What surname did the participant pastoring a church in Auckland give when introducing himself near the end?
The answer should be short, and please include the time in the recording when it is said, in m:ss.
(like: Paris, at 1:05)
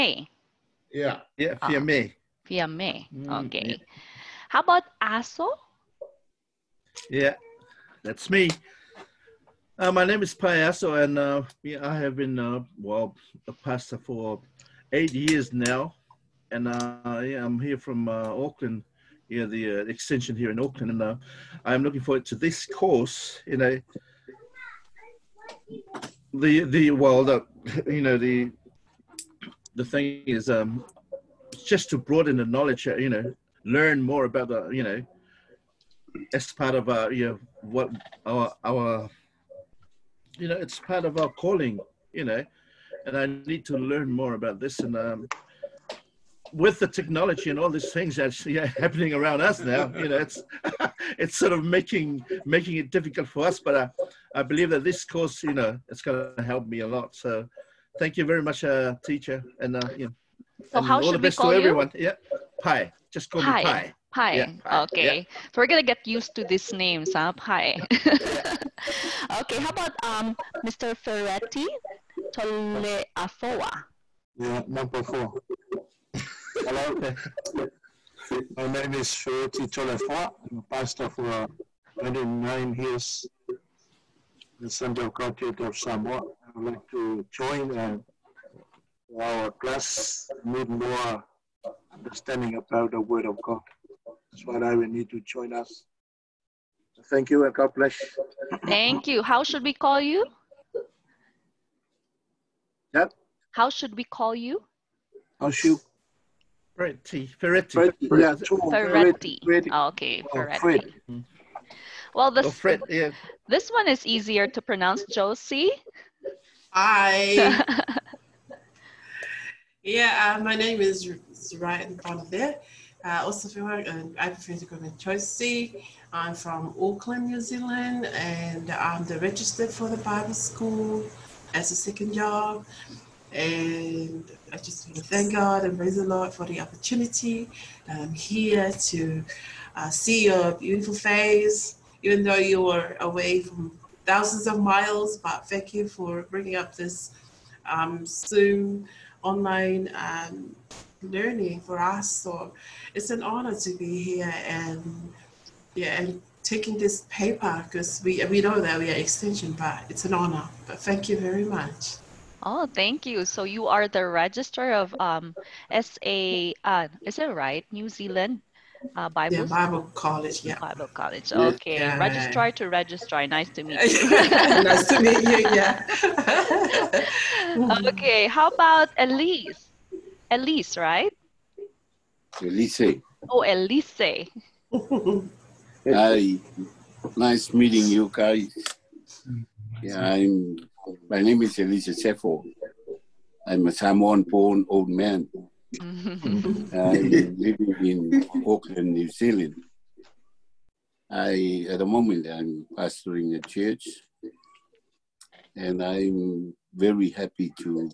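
Sefo, at 3:11.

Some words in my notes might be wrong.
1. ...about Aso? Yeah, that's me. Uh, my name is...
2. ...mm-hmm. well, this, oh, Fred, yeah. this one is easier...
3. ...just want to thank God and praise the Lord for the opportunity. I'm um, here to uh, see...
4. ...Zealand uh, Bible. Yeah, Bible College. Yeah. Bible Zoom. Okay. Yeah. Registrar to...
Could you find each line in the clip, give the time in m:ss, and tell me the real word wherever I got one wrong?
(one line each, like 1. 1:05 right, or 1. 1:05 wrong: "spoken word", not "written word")
1. 0:04 right
2. 1:51 right
3. 2:14 right
4. 2:47 wrong: "College", not "Zoom".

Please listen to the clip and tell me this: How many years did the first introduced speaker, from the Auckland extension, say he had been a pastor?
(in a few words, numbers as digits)
8.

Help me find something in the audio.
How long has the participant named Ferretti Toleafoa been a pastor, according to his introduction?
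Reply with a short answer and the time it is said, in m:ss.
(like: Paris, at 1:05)
29 years, at 1:21.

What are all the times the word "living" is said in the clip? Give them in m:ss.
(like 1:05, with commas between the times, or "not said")
3:16.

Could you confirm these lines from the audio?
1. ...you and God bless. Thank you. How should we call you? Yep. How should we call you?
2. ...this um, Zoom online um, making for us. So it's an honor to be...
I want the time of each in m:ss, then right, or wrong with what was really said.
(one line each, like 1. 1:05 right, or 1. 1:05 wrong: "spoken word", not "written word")
1. 1:37 right
2. 2:26 wrong: "learning", not "making".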